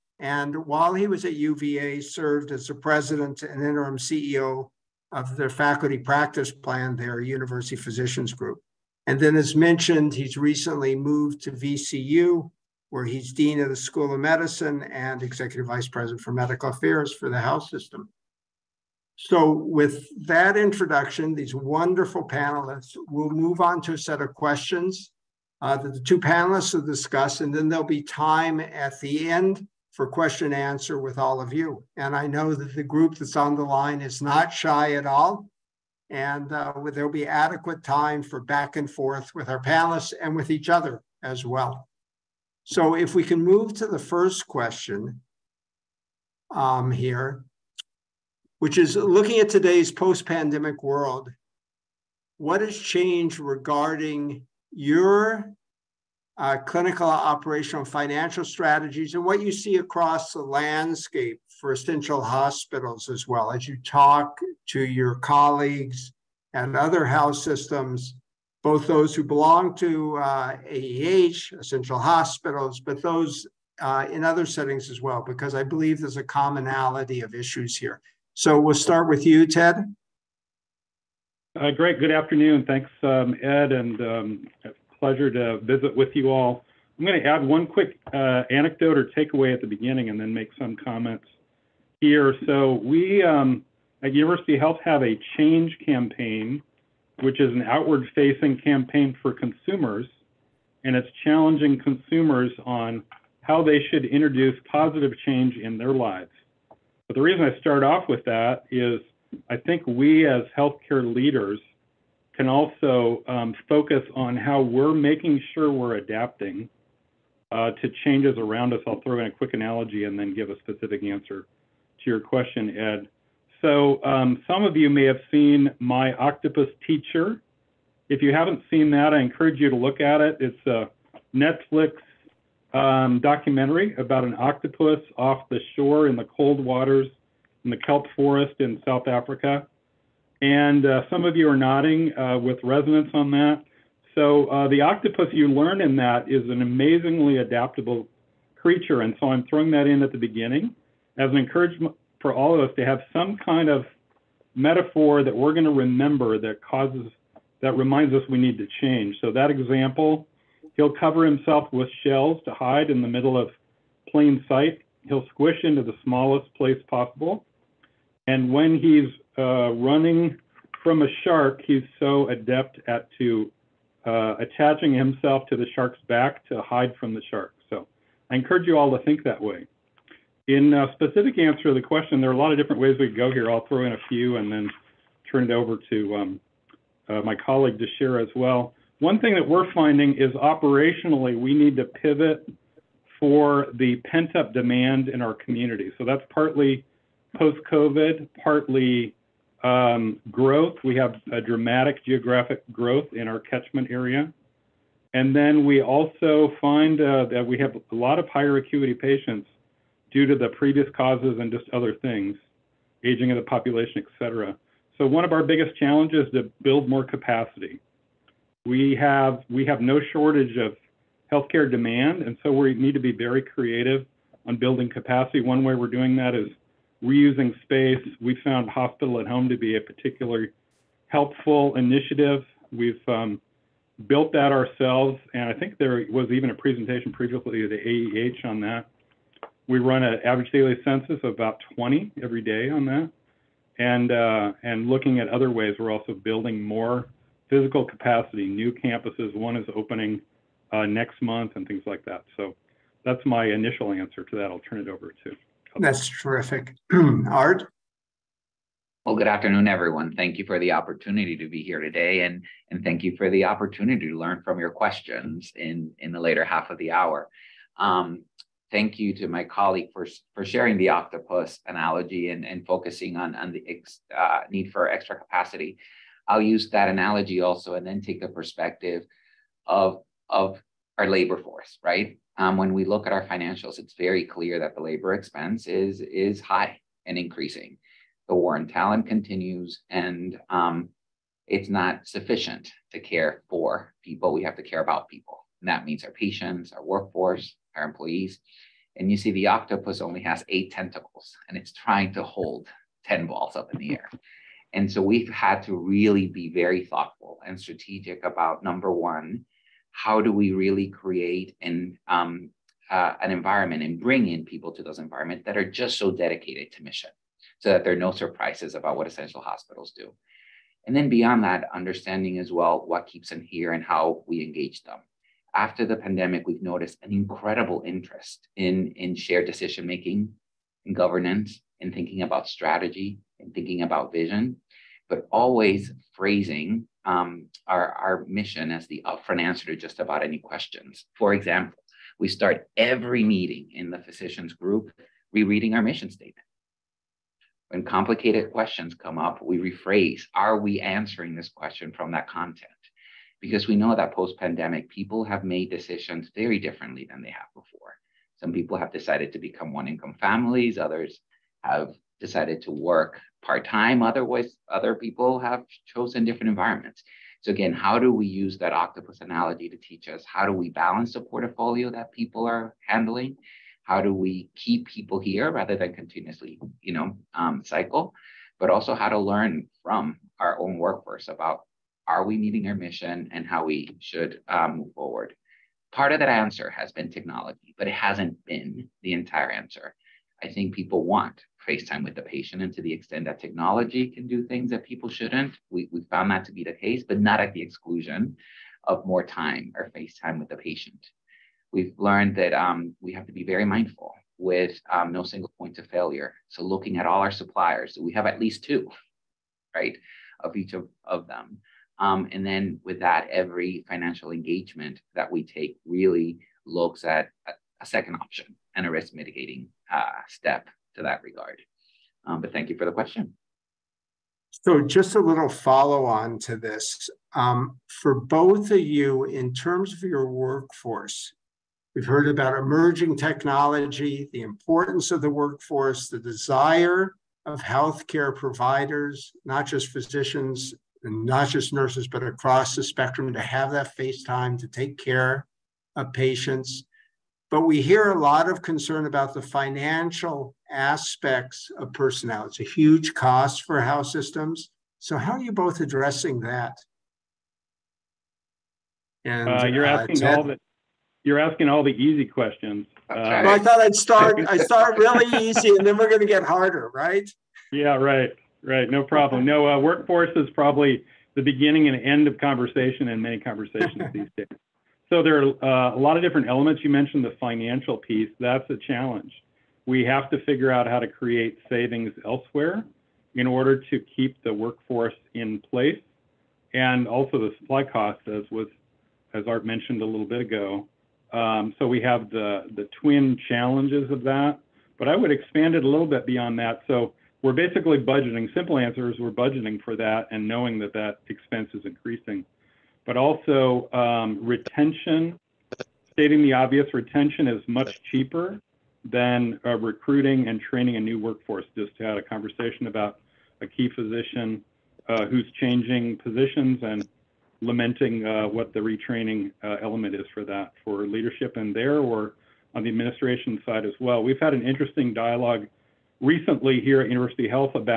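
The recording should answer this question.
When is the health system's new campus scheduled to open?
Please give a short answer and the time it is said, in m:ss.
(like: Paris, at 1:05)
next month, at 4:10.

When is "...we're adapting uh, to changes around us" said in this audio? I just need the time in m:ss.
1:55.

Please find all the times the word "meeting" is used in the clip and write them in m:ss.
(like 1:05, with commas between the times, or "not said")
5:43, 6:22.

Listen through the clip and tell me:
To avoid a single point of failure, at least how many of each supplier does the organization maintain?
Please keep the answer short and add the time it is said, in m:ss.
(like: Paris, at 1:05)
2, at 6:48.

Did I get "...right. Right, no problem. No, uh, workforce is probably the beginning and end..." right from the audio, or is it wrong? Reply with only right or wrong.
right.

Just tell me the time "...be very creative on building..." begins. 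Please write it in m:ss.
3:42.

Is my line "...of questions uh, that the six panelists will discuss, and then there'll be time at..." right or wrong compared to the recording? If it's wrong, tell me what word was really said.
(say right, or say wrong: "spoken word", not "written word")
wrong: "two", not "six".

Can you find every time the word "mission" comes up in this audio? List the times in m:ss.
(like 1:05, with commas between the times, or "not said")
5:16, 5:38, 5:45, 6:22.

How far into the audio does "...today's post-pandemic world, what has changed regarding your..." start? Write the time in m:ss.
0:49.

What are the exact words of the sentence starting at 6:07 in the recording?
So, again, how do we use that octopus analogy to teach us how do we balance the portfolio that people are handling?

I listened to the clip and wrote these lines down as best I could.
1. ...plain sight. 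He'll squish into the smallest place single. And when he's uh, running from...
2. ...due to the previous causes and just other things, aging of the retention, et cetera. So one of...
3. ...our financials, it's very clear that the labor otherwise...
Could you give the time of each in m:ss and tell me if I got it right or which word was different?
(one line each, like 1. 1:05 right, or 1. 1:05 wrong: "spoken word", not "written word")
1. 2:44 wrong: "possible", not "single"
2. 3:30 wrong: "population", not "retention"
3. 4:43 wrong: "expense", not "otherwise".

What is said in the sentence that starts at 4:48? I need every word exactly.
The war on talent continues and um, it's not sufficient to care for people.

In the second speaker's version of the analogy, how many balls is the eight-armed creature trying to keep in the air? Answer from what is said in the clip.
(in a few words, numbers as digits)
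10.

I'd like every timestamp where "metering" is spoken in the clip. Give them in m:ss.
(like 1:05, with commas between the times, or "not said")
not said.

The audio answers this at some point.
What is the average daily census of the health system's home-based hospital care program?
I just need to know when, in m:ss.
4:01.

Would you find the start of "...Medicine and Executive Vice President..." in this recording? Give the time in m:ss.
0:14.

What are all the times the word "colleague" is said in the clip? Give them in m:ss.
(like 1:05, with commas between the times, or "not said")
1:05, 3:07, 4:29.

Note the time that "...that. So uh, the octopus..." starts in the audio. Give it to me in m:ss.
2:23.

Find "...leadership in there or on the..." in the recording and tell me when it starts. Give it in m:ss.
8:41.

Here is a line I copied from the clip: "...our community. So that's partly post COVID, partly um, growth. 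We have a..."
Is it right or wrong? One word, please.
right.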